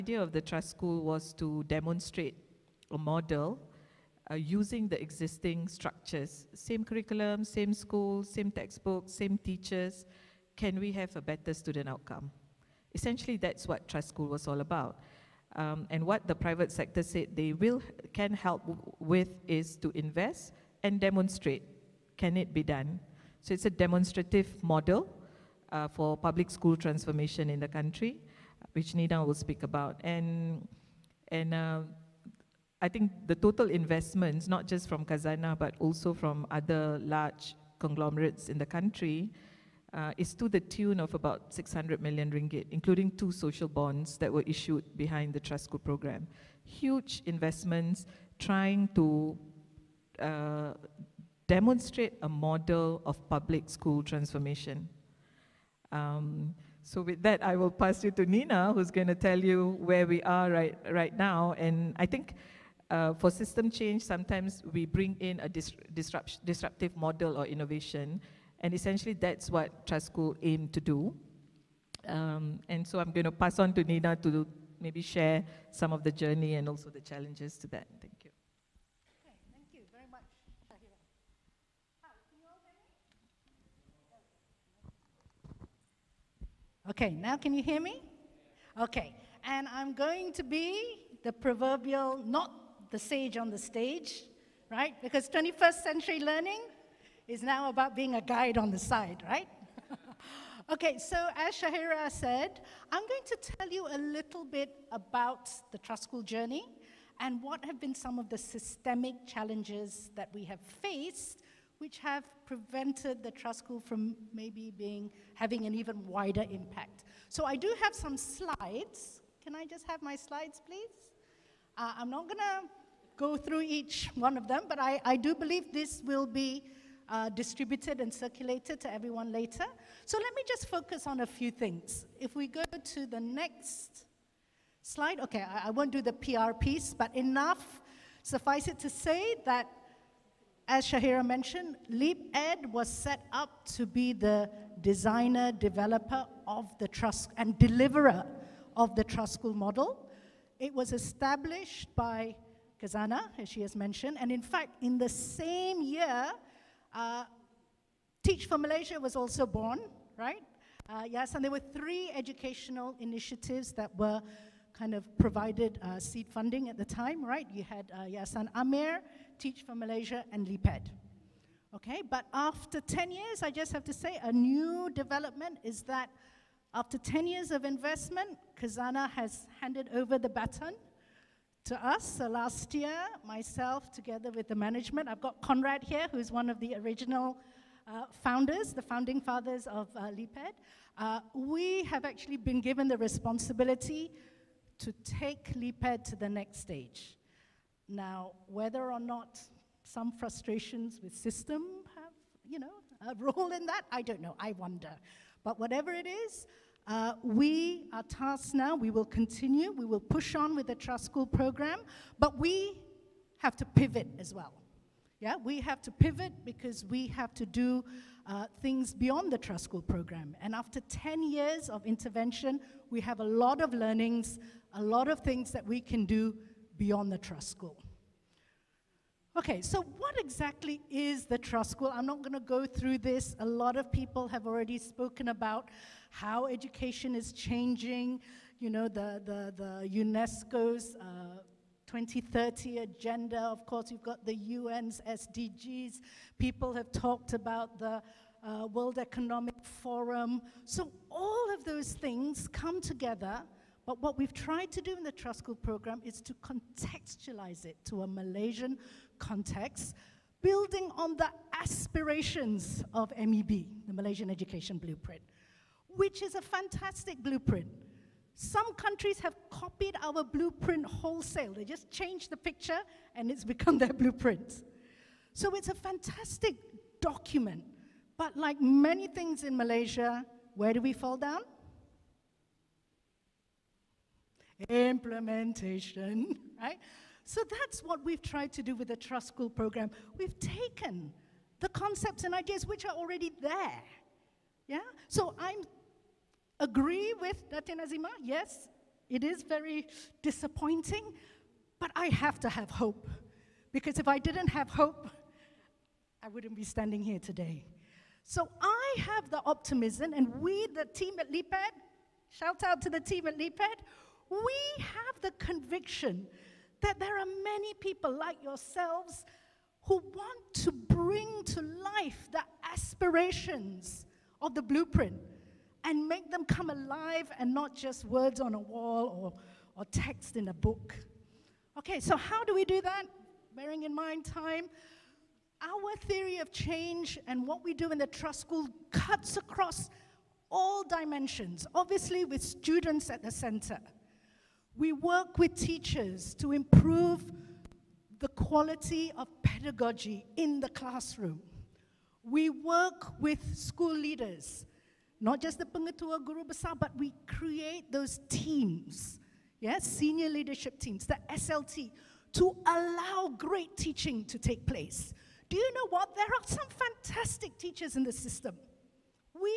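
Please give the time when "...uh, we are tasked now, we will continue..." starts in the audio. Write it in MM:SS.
03:26.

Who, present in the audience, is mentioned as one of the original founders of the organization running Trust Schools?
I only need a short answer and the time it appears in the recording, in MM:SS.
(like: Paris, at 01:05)
Conrad, at 03:05.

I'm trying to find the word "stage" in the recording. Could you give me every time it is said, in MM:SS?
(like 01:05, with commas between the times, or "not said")
01:33, 03:16.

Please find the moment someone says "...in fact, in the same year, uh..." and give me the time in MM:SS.
02:34.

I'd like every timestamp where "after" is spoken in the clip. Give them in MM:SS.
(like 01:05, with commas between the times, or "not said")
02:52, 02:56, 03:40.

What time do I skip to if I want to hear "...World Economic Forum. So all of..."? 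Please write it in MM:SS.
04:08.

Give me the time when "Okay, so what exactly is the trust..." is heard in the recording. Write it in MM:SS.
03:49.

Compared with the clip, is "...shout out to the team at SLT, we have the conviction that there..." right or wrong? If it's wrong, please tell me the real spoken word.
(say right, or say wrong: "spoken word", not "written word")
wrong: "LeapEd", not "SLT".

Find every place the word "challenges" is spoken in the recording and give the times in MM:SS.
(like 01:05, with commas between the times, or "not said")
01:17, 01:49.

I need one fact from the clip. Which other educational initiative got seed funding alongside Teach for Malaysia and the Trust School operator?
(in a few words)
Yayasan AMIR.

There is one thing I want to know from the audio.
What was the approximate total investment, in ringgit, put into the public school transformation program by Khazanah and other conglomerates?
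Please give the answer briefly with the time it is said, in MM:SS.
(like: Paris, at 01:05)
600 million ringgit, at 00:41.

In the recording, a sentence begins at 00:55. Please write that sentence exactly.
Um, so with that, I will pass you to Nina, who's going to tell you where we are right, right now.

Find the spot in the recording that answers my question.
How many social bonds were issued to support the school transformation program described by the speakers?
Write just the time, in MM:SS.
00:43.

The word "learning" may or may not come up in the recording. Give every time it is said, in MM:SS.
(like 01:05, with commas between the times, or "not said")
01:36, 03:43.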